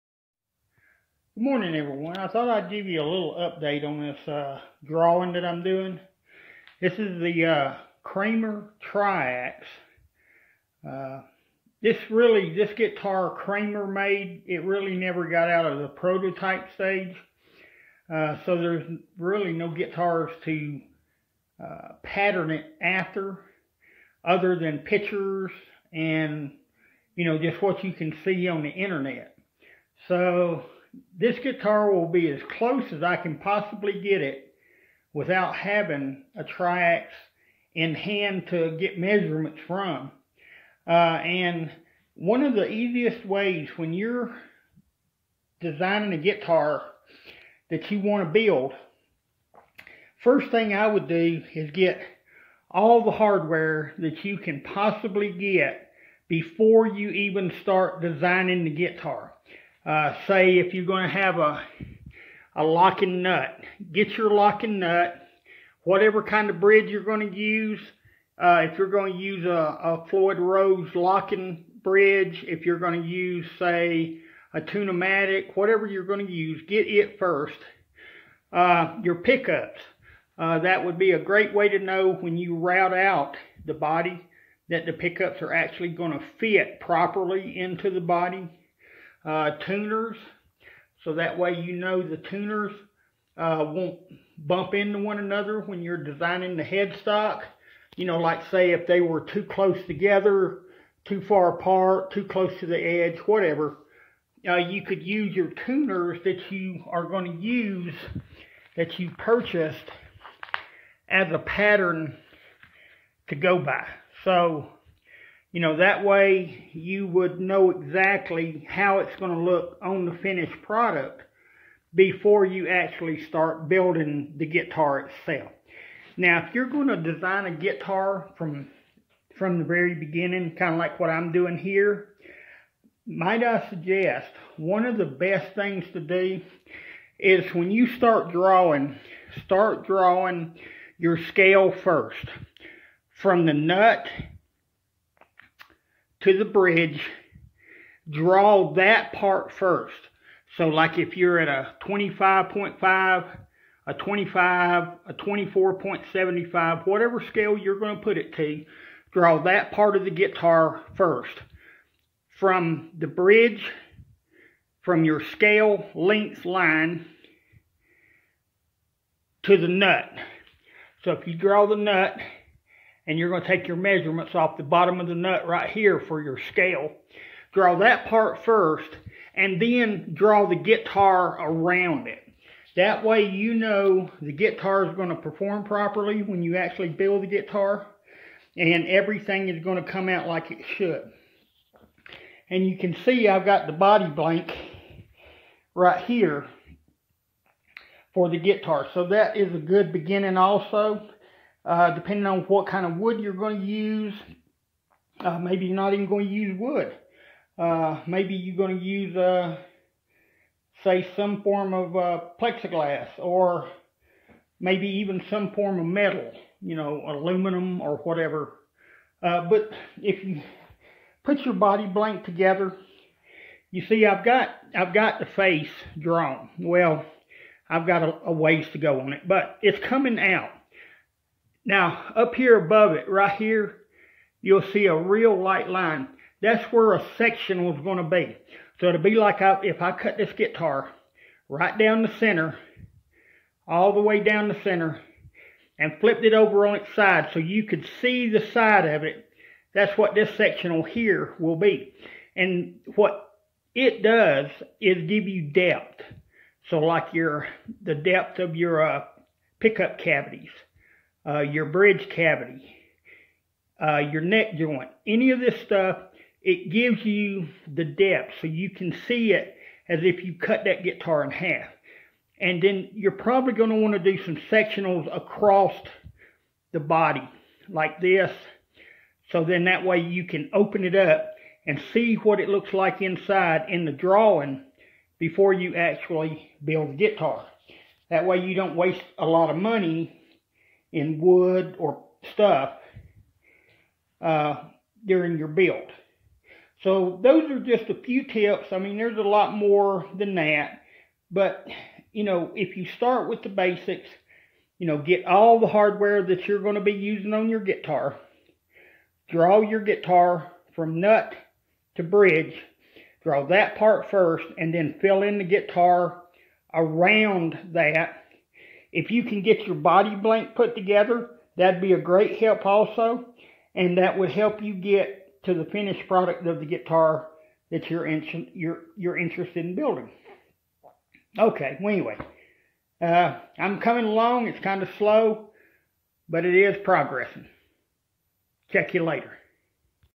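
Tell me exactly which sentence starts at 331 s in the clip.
Okay, well, anyway, uh, I'm coming along.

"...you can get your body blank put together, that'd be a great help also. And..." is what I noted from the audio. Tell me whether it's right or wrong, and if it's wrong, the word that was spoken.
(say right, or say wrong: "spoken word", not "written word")
right.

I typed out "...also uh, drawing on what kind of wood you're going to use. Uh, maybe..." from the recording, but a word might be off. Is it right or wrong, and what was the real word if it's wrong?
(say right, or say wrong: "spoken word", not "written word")
wrong: "depending", not "drawing".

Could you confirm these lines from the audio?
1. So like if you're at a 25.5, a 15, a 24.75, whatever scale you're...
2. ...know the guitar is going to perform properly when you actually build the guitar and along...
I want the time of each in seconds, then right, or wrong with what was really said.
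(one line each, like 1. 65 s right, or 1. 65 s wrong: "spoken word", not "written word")
1. 150 s wrong: "25", not "15"
2. 183 s wrong: "everything", not "along".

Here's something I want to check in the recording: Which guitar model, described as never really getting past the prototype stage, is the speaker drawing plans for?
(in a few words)
Kramer Triax.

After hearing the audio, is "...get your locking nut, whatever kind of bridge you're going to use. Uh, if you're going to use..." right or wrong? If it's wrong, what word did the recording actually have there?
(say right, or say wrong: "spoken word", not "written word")
right.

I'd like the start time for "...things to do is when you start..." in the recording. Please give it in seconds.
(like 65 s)
135 s.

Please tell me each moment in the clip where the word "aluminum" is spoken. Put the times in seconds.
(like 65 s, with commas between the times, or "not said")
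217 s.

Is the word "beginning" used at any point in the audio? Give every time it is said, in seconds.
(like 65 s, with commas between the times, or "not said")
129 s, 199 s.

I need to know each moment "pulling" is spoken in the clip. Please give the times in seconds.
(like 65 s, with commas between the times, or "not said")
not said.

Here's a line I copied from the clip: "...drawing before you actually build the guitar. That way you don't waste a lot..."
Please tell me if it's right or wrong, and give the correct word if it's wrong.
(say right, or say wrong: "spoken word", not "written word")
right.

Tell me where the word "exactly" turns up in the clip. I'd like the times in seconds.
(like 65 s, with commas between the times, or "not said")
117 s.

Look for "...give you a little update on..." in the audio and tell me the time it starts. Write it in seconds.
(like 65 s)
2 s.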